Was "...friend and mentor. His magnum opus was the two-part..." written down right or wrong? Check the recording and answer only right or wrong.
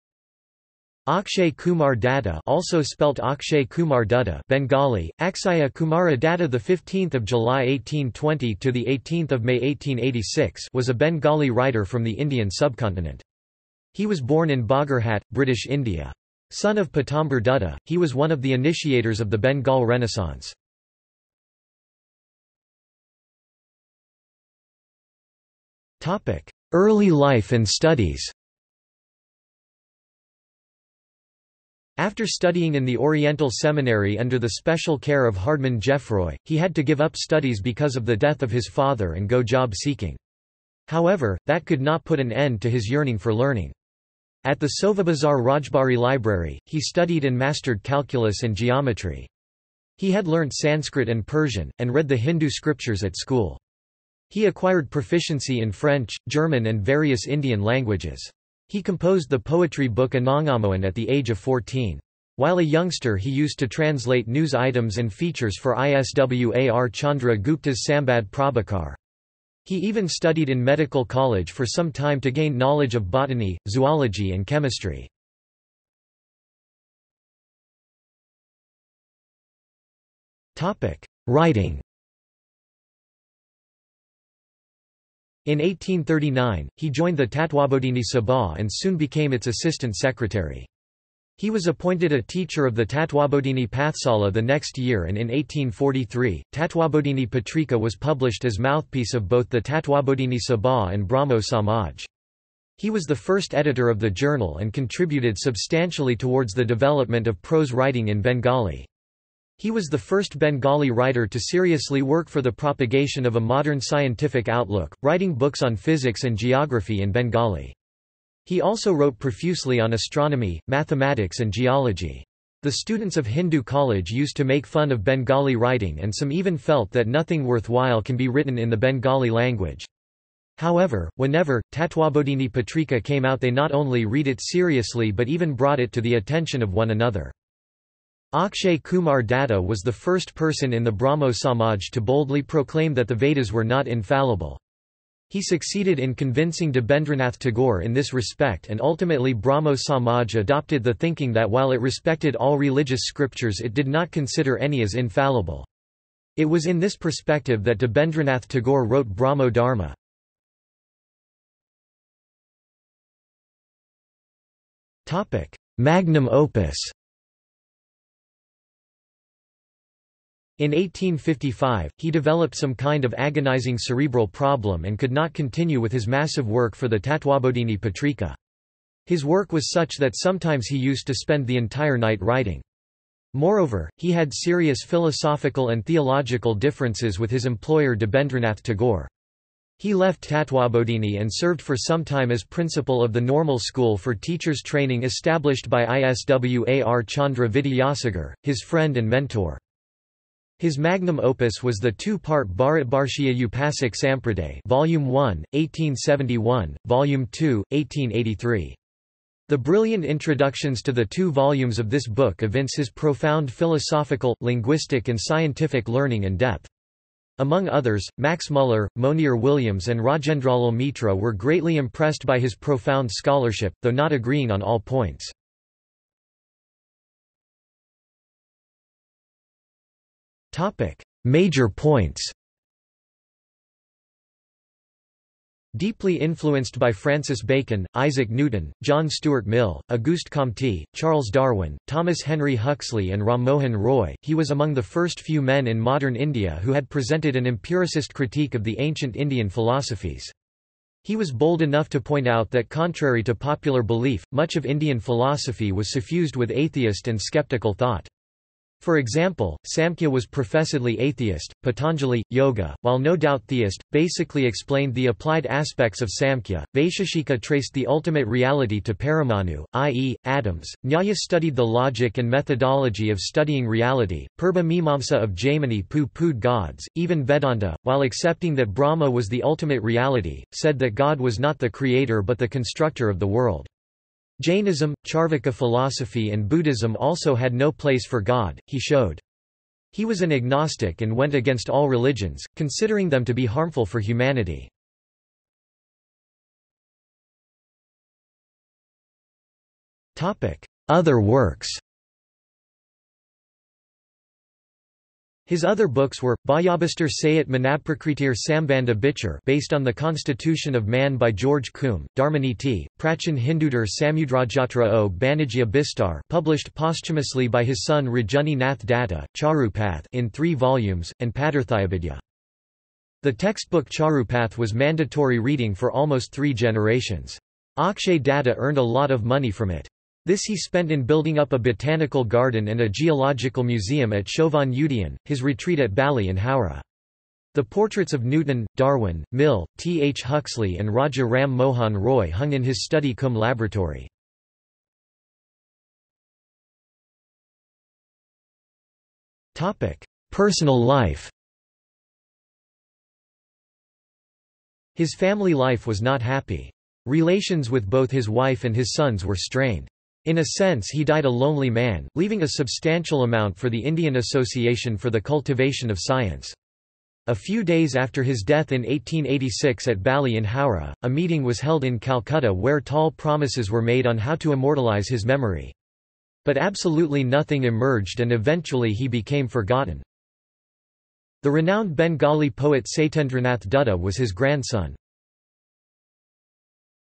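right.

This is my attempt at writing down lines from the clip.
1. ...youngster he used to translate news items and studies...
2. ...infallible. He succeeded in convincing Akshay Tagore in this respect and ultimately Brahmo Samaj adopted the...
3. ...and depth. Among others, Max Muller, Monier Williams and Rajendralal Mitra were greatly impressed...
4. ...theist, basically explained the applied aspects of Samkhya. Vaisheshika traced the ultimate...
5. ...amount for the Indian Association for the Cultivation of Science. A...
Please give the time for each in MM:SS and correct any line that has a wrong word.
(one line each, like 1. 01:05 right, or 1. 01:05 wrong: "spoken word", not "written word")
1. 01:02 wrong: "features", not "studies"
2. 02:23 wrong: "Debendranath", not "Akshay"
3. 03:36 right
4. 04:23 right
5. 06:03 right.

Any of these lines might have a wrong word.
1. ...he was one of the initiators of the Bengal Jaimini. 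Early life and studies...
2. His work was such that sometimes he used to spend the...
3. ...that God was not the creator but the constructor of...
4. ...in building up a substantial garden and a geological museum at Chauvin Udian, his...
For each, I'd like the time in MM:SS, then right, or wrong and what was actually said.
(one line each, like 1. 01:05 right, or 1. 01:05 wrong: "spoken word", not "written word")
1. 00:17 wrong: "Renaissance", not "Jaimini"
2. 02:59 right
3. 04:40 right
4. 05:30 wrong: "botanical", not "substantial".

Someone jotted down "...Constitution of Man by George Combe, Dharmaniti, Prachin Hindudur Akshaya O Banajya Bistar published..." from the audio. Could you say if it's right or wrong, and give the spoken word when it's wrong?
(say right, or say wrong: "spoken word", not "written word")
wrong: "Samudrajatra", not "Akshaya".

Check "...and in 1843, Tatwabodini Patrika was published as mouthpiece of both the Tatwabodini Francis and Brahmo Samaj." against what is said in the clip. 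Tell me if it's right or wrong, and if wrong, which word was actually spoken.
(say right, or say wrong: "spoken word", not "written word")
wrong: "Sabha", not "Francis".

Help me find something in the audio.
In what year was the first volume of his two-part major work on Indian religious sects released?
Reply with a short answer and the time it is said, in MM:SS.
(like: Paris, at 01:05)
1871, at 03:25.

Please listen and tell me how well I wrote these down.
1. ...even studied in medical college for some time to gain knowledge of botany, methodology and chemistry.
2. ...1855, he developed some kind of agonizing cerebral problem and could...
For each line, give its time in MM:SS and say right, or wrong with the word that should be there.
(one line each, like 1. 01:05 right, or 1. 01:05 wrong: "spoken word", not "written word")
1. 01:09 wrong: "zoology", not "methodology"
2. 02:50 right.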